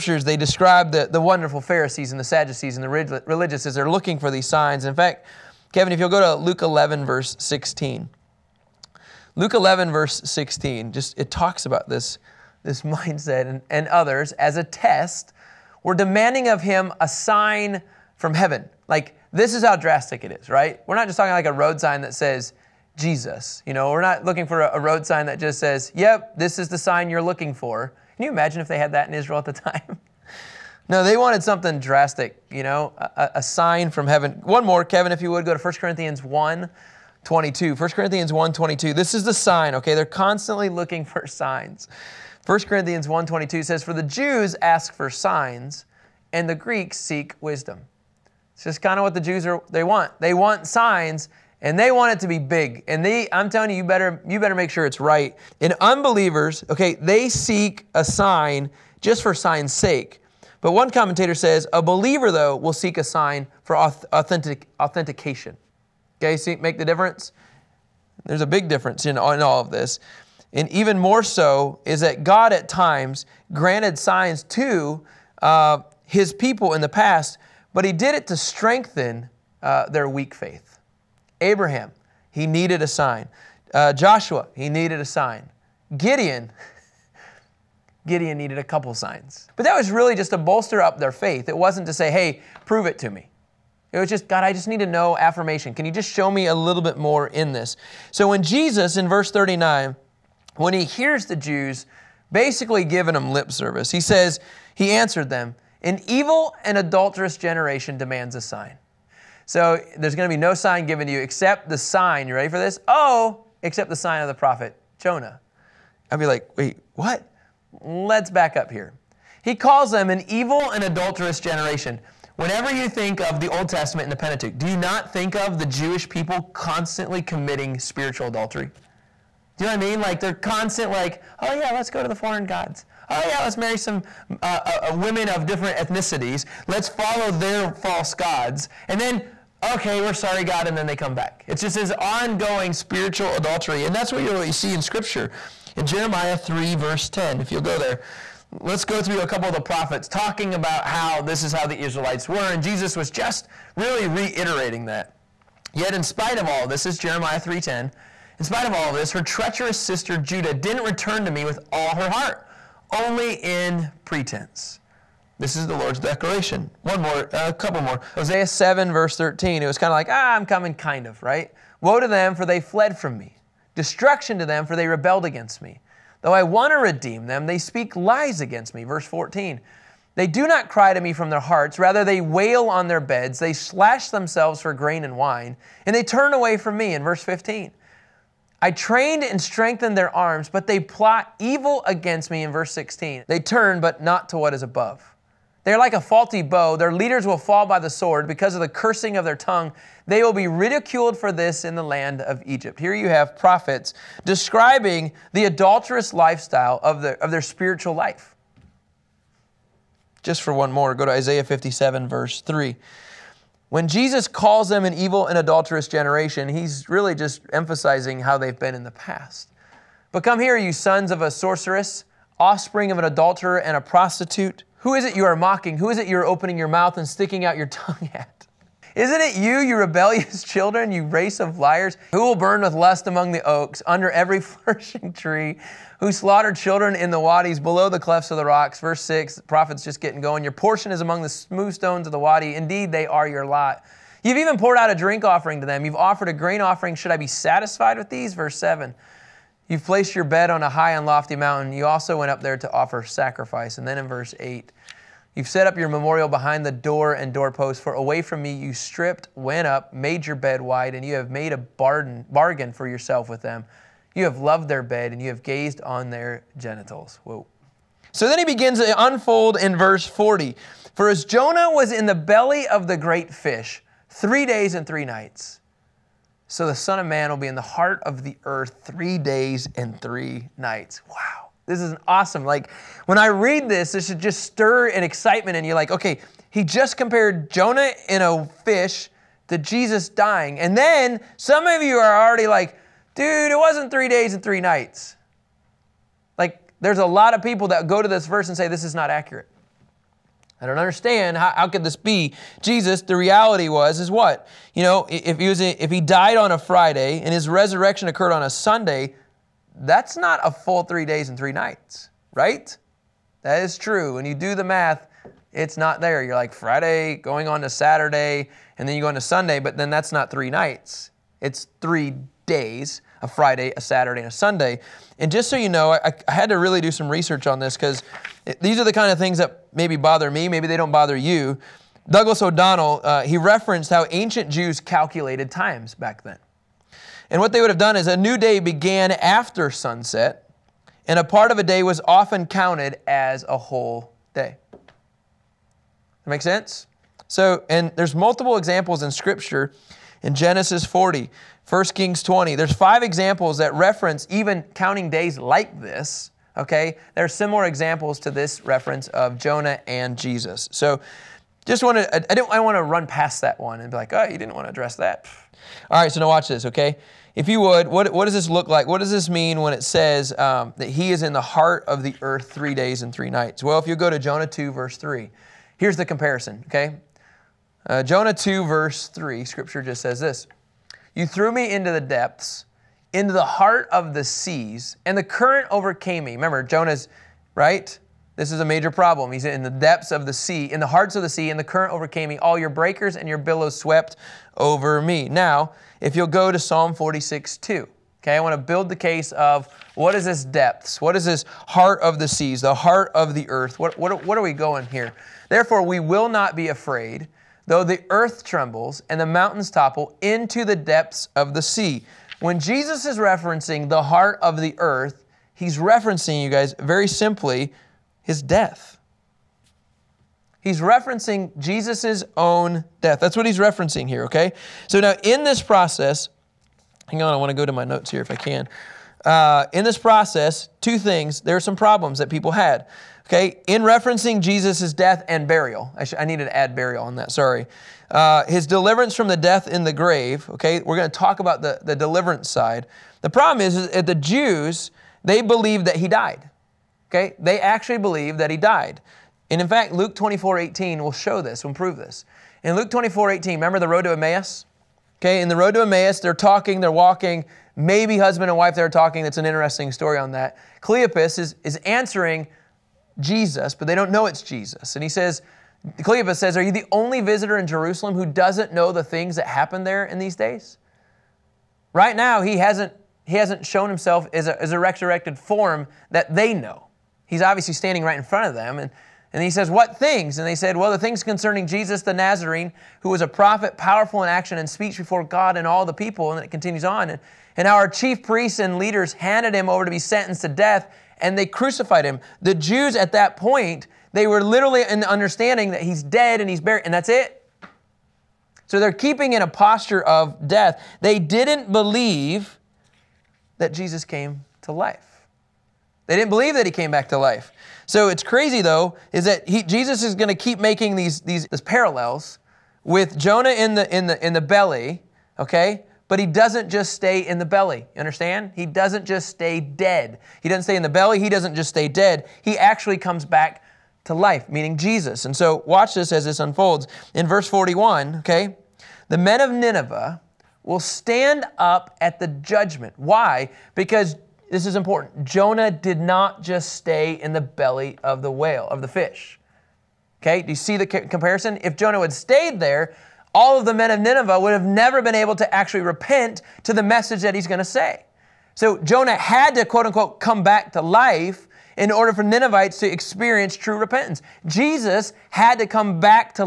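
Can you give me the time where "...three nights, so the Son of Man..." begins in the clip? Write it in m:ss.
4:34.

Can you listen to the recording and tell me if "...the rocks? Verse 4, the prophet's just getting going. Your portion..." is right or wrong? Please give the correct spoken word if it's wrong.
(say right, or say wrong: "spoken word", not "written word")
wrong: "6", not "4".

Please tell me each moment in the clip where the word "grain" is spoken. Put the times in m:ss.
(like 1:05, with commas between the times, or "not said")
3:04, 4:06.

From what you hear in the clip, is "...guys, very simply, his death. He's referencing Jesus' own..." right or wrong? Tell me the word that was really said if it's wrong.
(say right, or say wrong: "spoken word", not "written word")
right.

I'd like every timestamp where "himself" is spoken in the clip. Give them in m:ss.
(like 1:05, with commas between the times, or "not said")
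7:53.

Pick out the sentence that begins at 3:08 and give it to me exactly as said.
I trained and strengthened their arms, but they plot evil against me.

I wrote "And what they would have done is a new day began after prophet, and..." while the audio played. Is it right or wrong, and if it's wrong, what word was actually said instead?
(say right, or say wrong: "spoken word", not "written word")
wrong: "sunset", not "prophet".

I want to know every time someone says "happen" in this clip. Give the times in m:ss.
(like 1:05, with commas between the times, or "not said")
7:49.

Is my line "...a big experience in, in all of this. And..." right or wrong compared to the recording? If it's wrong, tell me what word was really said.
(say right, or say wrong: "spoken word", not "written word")
wrong: "difference", not "experience".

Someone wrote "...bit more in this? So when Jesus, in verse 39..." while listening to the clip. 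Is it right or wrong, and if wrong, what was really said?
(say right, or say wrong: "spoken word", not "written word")
right.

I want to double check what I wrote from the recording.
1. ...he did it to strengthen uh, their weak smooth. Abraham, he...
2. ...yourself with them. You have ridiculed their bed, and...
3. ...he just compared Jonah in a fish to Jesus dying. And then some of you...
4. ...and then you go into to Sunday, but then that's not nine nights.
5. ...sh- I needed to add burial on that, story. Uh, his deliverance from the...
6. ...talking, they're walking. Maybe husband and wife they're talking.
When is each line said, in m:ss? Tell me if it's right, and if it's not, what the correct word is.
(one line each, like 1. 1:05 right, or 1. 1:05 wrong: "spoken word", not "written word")
1. 1:17 wrong: "faith", not "smooth"
2. 4:22 wrong: "loved", not "ridiculed"
3. 4:46 right
4. 5:18 wrong: "three", not "nine"
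5. 7:16 wrong: "sorry", not "story"
6. 7:36 right.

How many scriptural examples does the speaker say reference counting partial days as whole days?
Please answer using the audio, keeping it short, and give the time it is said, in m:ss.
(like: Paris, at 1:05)
5, at 5:52.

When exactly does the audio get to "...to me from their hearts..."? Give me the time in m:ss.
3:00.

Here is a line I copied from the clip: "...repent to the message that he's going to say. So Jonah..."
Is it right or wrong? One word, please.
right.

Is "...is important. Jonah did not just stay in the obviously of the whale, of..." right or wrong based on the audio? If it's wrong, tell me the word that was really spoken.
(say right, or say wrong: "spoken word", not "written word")
wrong: "belly", not "obviously".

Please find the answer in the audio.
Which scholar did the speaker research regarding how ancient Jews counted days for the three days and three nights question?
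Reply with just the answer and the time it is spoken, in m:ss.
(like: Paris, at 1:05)
Douglas O'Donnell, at 5:32.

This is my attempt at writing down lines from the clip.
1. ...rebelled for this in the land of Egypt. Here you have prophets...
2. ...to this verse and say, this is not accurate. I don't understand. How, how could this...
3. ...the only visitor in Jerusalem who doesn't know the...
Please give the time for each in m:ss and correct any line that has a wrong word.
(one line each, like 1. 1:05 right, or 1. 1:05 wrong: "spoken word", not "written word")
1. 3:20 wrong: "ridiculed", not "rebelled"
2. 4:58 right
3. 7:46 right.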